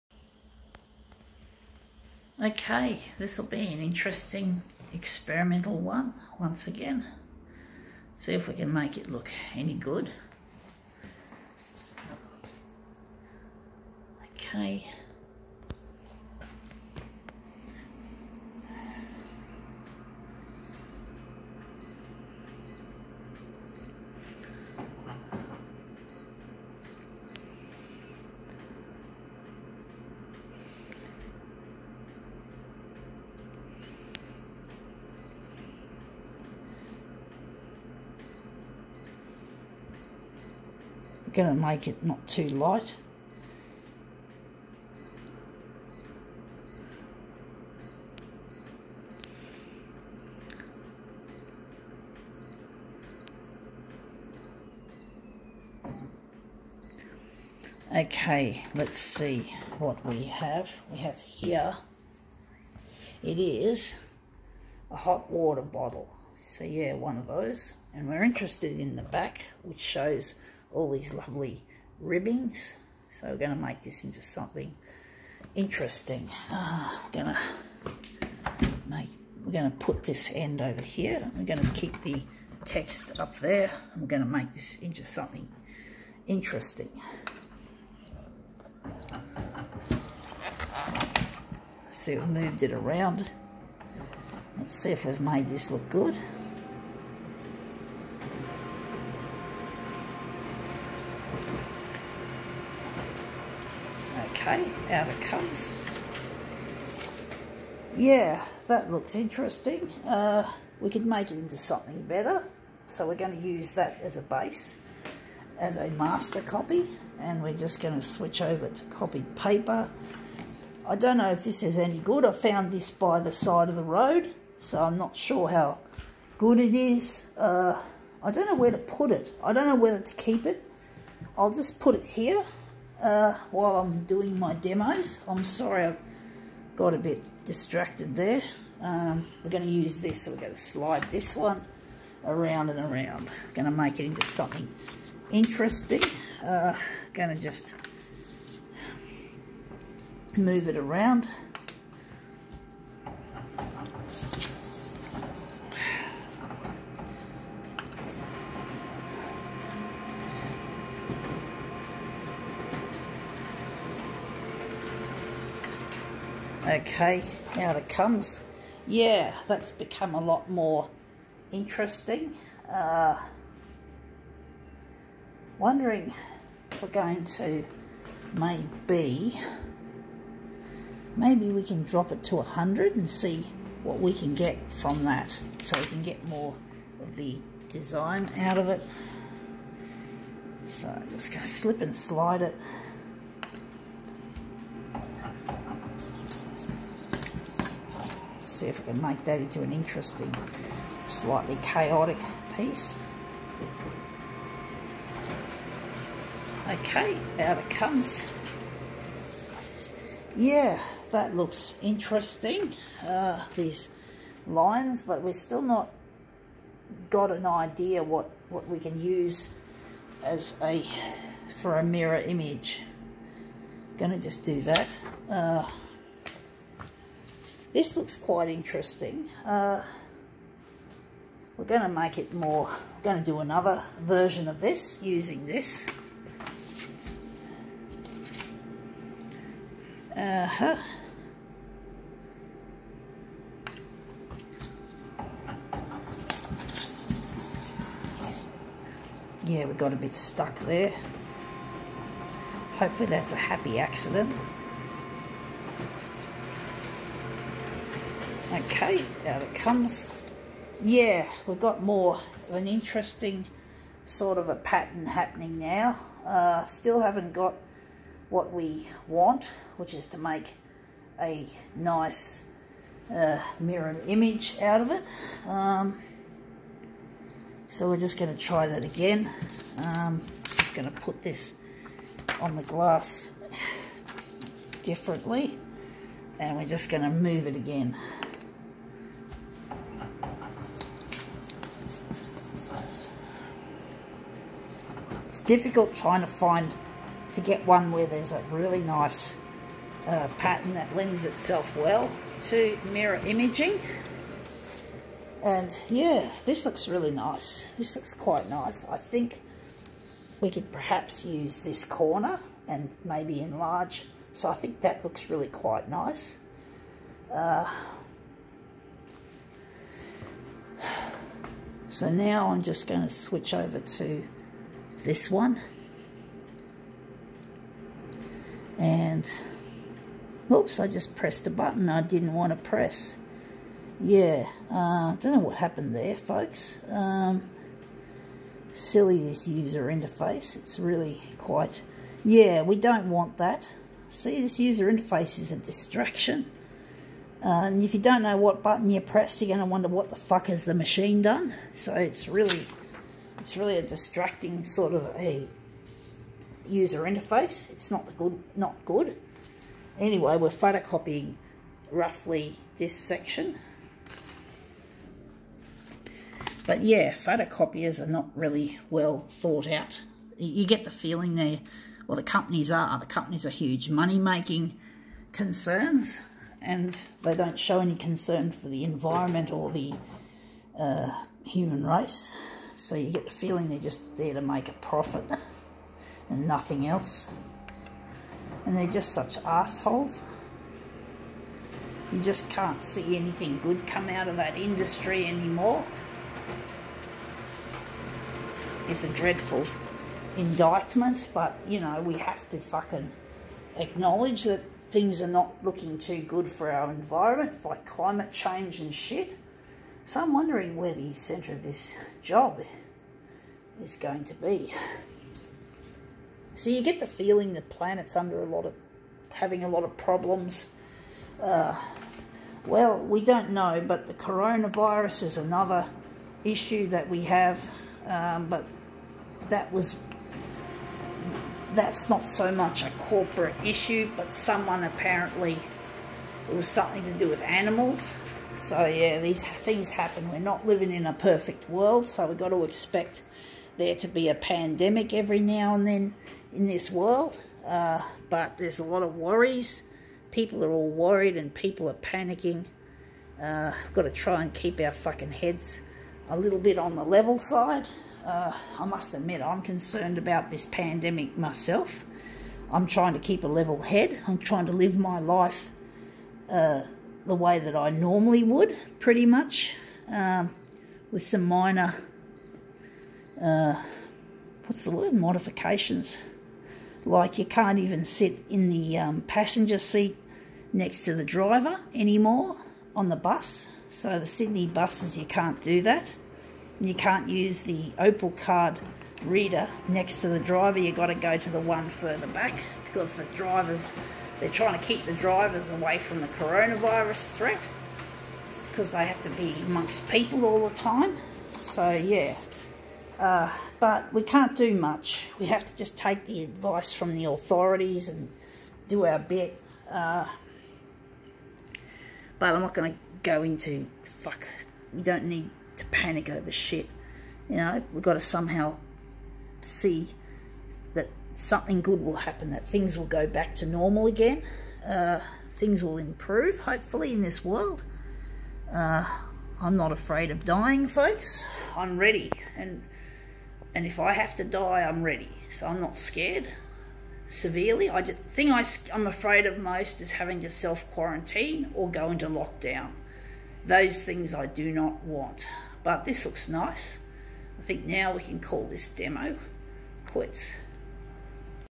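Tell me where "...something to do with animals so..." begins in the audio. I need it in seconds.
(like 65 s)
436 s.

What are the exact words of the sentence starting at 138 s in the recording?
Um, we're going to use this, so we're going to slide this one around and around.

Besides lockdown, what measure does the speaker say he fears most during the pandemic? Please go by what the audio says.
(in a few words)
self-quarantine.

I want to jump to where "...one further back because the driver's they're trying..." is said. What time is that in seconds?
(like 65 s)
491 s.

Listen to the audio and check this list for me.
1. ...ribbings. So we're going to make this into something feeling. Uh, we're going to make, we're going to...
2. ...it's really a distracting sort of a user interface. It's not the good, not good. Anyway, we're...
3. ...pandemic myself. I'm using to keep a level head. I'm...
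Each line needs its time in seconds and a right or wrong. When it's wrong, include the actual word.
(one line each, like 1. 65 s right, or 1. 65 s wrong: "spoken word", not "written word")
1. 72 s wrong: "interesting", not "feeling"
2. 353 s right
3. 460 s wrong: "trying", not "using".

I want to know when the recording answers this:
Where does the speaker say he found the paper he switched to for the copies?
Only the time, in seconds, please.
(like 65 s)
122 s.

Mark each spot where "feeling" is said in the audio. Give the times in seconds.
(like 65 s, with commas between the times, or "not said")
370 s, 383 s, 417 s.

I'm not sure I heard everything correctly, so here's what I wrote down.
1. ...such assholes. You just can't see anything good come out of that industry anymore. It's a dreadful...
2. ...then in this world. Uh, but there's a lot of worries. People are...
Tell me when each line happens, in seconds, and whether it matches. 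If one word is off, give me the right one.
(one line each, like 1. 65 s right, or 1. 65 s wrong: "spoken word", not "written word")
1. 389 s right
2. 445 s right.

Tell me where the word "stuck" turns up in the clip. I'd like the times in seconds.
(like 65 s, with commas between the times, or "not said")
250 s.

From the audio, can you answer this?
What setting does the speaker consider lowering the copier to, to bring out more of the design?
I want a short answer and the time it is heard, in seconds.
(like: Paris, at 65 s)
100, at 182 s.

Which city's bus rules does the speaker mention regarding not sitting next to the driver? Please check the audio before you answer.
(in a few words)
Sydney.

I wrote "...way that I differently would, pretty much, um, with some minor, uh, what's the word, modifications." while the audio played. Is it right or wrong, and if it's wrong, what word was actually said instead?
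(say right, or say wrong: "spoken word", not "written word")
wrong: "normally", not "differently".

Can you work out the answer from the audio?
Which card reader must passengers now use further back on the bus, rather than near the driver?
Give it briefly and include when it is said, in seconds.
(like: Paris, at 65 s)
Opal, at 487 s.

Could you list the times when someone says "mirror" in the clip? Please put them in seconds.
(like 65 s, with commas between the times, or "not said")
221 s, 273 s, 302 s.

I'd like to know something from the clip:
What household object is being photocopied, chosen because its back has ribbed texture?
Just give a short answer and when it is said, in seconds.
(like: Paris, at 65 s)
hot water bottle, at 64 s.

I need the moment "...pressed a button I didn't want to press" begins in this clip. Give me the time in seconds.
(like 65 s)
331 s.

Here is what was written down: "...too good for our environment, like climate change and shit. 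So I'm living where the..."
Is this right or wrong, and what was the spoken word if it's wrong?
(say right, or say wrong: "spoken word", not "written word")
wrong: "wondering", not "living".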